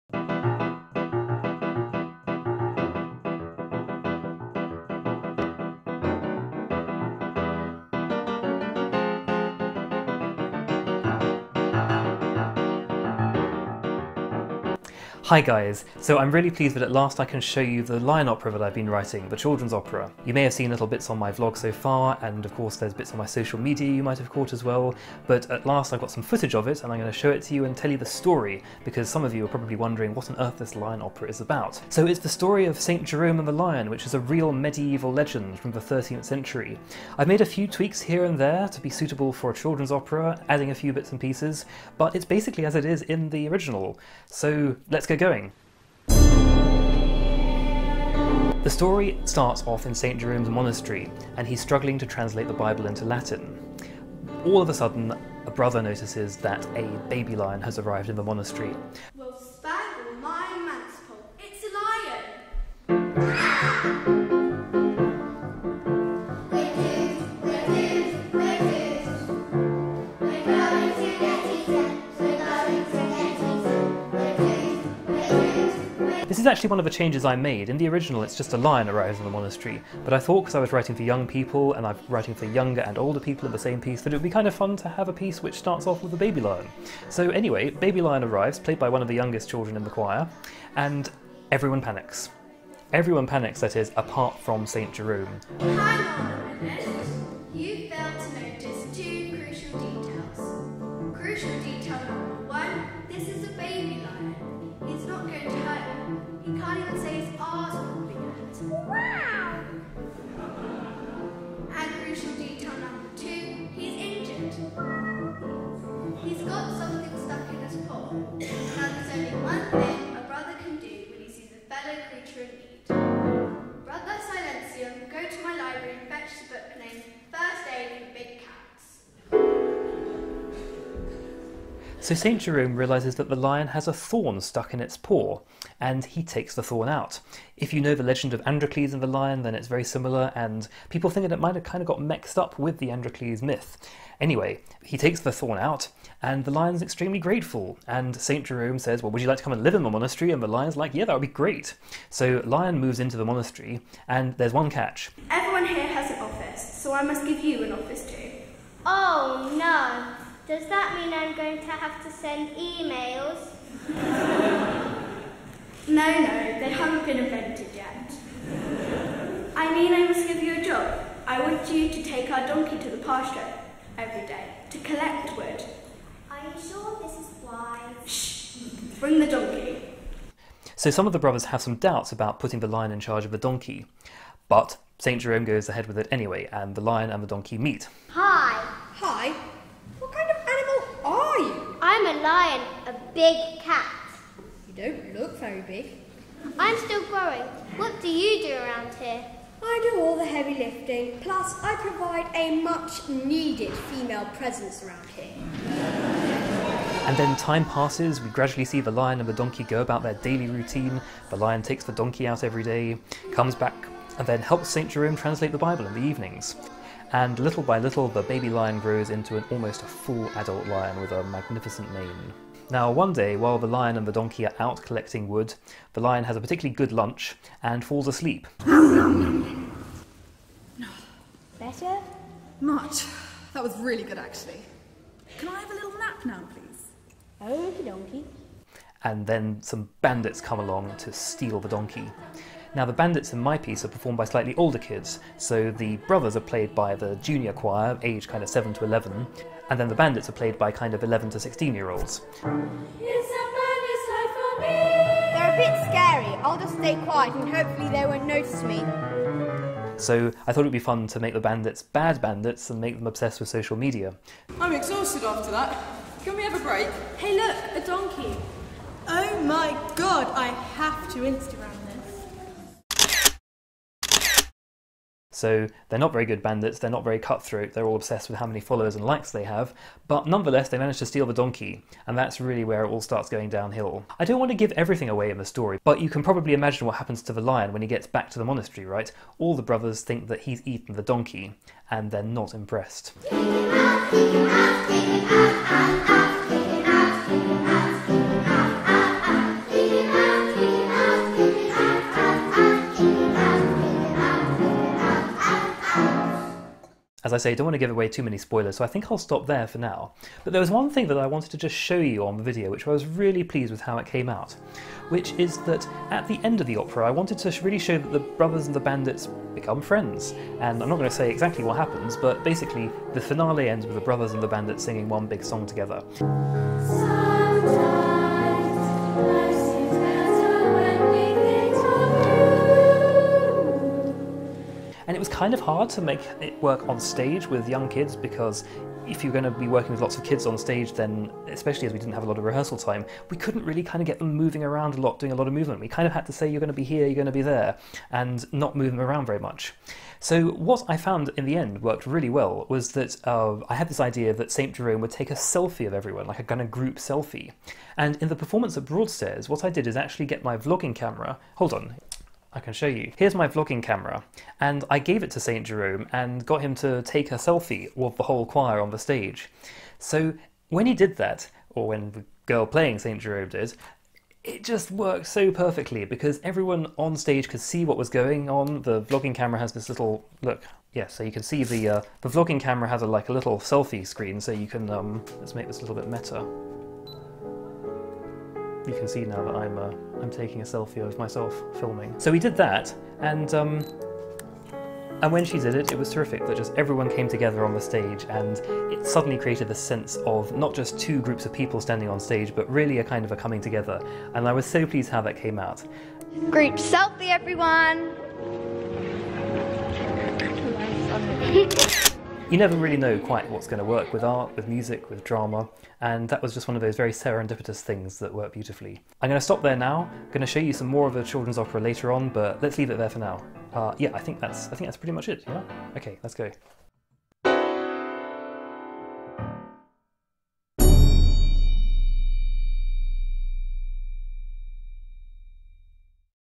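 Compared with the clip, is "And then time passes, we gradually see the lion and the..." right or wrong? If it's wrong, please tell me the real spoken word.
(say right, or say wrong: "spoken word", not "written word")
right.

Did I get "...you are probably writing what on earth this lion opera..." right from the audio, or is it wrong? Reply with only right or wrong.
wrong.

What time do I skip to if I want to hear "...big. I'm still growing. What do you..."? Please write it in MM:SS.
03:15.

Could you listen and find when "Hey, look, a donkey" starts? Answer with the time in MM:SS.
04:27.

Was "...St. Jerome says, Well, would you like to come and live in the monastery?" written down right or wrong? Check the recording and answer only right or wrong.
right.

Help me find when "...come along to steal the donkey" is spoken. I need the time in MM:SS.
04:00.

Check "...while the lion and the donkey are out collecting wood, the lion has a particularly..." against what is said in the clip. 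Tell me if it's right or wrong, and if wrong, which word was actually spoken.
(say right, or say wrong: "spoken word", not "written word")
right.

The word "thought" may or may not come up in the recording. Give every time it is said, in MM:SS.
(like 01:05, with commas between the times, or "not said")
01:20, 04:20.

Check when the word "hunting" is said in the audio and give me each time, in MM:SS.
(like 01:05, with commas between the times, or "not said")
not said.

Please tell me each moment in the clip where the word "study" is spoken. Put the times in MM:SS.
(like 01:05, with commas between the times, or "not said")
not said.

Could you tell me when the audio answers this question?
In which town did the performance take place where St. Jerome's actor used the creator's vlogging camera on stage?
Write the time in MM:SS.
05:58.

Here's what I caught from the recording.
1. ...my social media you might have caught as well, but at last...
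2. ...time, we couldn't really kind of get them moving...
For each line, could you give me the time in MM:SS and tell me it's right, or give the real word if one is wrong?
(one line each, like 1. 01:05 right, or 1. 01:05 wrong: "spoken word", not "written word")
1. 00:23 right
2. 05:42 right.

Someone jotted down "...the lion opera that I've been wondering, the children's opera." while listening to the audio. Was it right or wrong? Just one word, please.
wrong.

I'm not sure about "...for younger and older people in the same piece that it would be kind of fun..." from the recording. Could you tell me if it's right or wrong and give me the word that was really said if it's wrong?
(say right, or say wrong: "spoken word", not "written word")
right.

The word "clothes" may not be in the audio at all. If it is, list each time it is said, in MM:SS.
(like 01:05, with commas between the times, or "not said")
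not said.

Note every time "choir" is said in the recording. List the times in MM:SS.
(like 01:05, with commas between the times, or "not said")
01:29, 04:07, 06:08.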